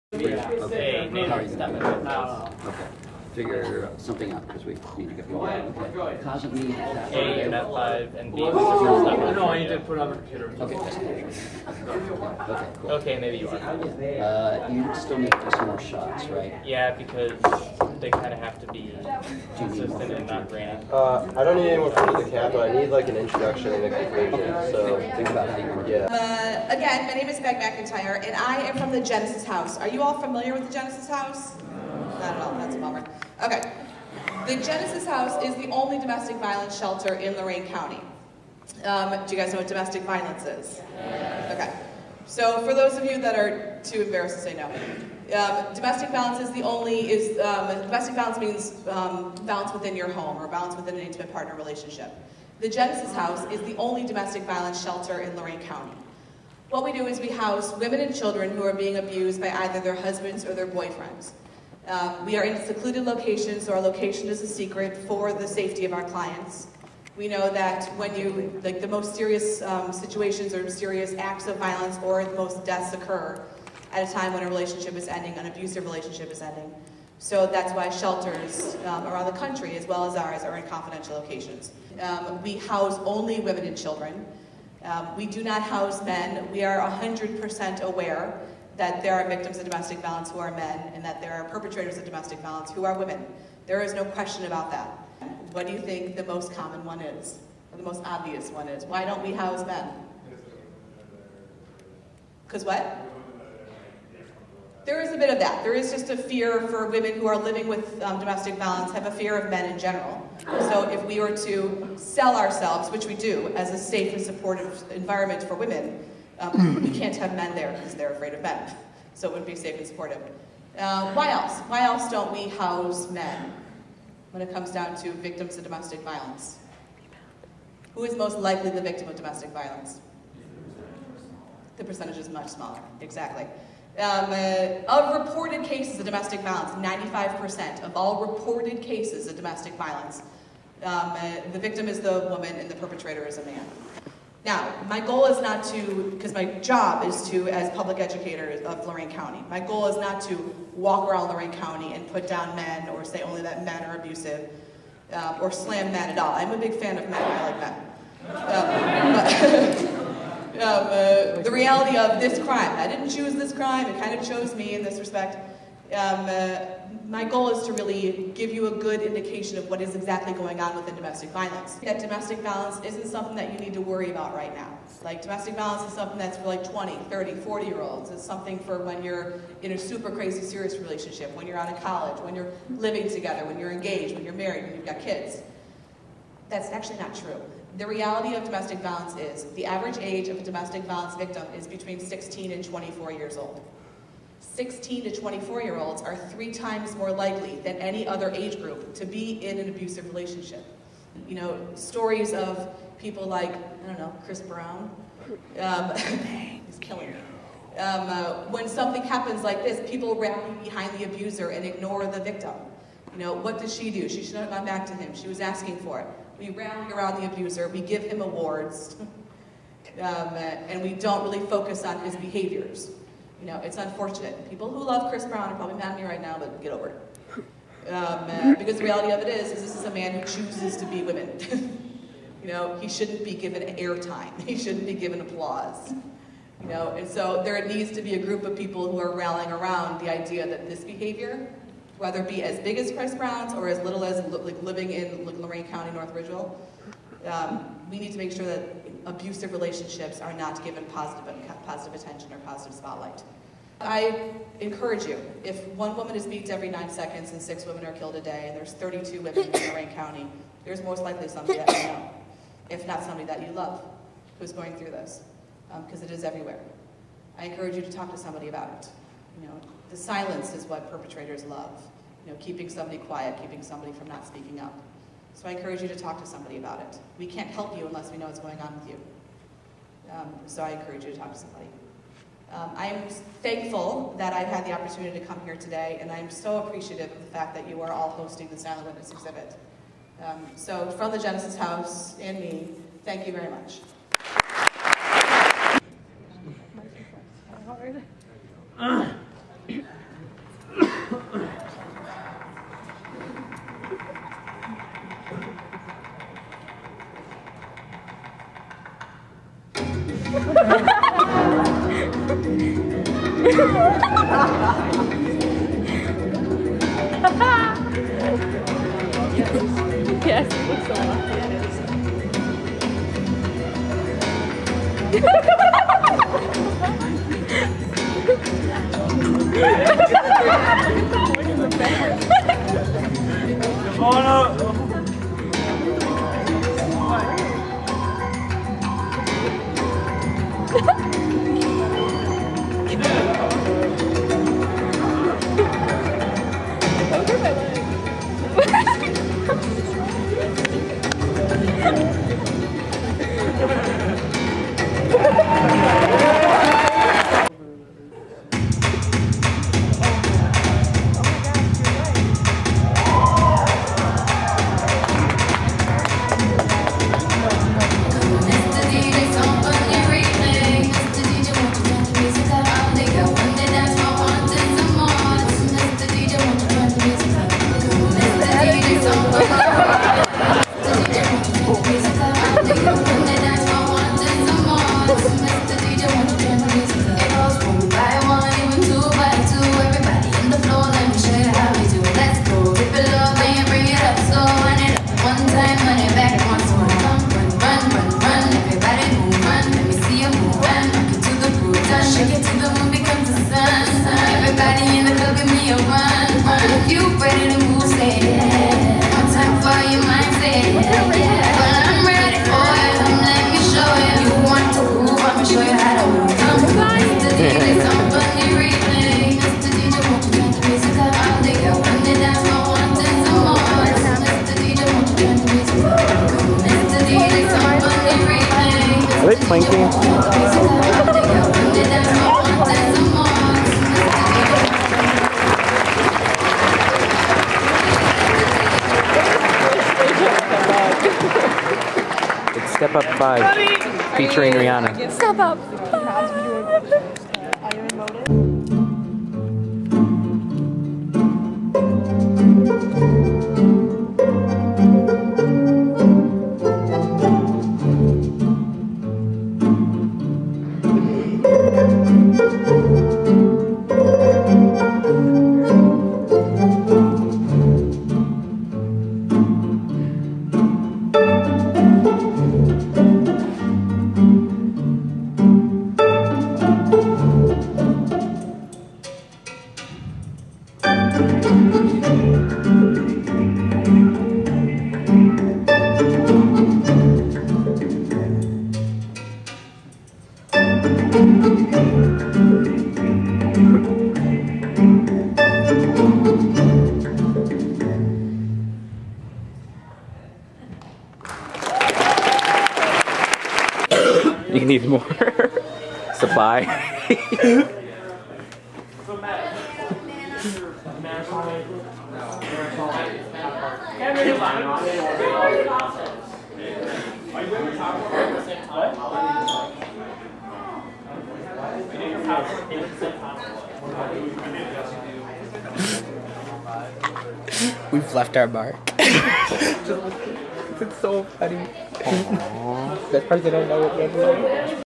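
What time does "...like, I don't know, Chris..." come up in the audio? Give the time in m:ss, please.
3:23.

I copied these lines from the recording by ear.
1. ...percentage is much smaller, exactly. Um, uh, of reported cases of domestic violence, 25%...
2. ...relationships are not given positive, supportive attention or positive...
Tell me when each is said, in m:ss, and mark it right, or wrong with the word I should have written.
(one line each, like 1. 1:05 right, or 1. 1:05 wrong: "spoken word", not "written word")
1. 2:11 wrong: "95", not "25"
2. 4:09 wrong: "positive", not "supportive".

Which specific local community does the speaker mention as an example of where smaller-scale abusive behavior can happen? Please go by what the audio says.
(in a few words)
North Ridgeville.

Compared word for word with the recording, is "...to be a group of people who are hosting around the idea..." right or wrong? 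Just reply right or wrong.
wrong.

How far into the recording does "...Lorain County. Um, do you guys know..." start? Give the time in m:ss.
0:37.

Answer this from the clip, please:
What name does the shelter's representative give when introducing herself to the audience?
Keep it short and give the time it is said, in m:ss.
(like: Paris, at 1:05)
Meg McIntyre, at 0:27.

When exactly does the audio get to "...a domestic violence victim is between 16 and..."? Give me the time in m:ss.
3:10.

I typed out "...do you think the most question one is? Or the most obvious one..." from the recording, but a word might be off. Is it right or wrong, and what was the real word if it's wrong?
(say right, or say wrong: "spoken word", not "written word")
wrong: "common", not "question".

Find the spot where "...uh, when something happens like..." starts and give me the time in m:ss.
3:28.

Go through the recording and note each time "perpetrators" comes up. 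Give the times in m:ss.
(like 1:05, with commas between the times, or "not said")
1:31, 2:22, 4:30.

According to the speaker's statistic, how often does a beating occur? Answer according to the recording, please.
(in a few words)
every 9 seconds.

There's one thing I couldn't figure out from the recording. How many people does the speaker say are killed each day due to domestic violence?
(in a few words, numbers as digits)
6.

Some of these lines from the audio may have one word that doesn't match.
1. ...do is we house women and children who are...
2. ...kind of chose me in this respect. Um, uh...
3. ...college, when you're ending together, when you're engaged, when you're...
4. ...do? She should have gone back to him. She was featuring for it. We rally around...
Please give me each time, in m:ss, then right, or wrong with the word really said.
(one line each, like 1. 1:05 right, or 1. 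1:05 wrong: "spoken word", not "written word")
1. 0:56 right
2. 2:44 right
3. 3:01 wrong: "living", not "ending"
4. 3:33 wrong: "asking", not "featuring".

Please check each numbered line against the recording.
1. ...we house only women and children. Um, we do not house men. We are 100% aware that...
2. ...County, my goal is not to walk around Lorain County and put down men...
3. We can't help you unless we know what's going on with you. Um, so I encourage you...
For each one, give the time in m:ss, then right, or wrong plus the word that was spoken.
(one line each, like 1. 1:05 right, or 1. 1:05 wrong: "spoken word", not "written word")
1. 1:22 right
2. 2:29 right
3. 4:37 right.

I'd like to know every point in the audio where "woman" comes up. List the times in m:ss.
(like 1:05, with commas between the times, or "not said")
2:22, 4:15.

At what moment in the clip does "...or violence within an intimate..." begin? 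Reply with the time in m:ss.
0:50.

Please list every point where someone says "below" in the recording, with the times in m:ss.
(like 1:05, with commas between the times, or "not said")
not said.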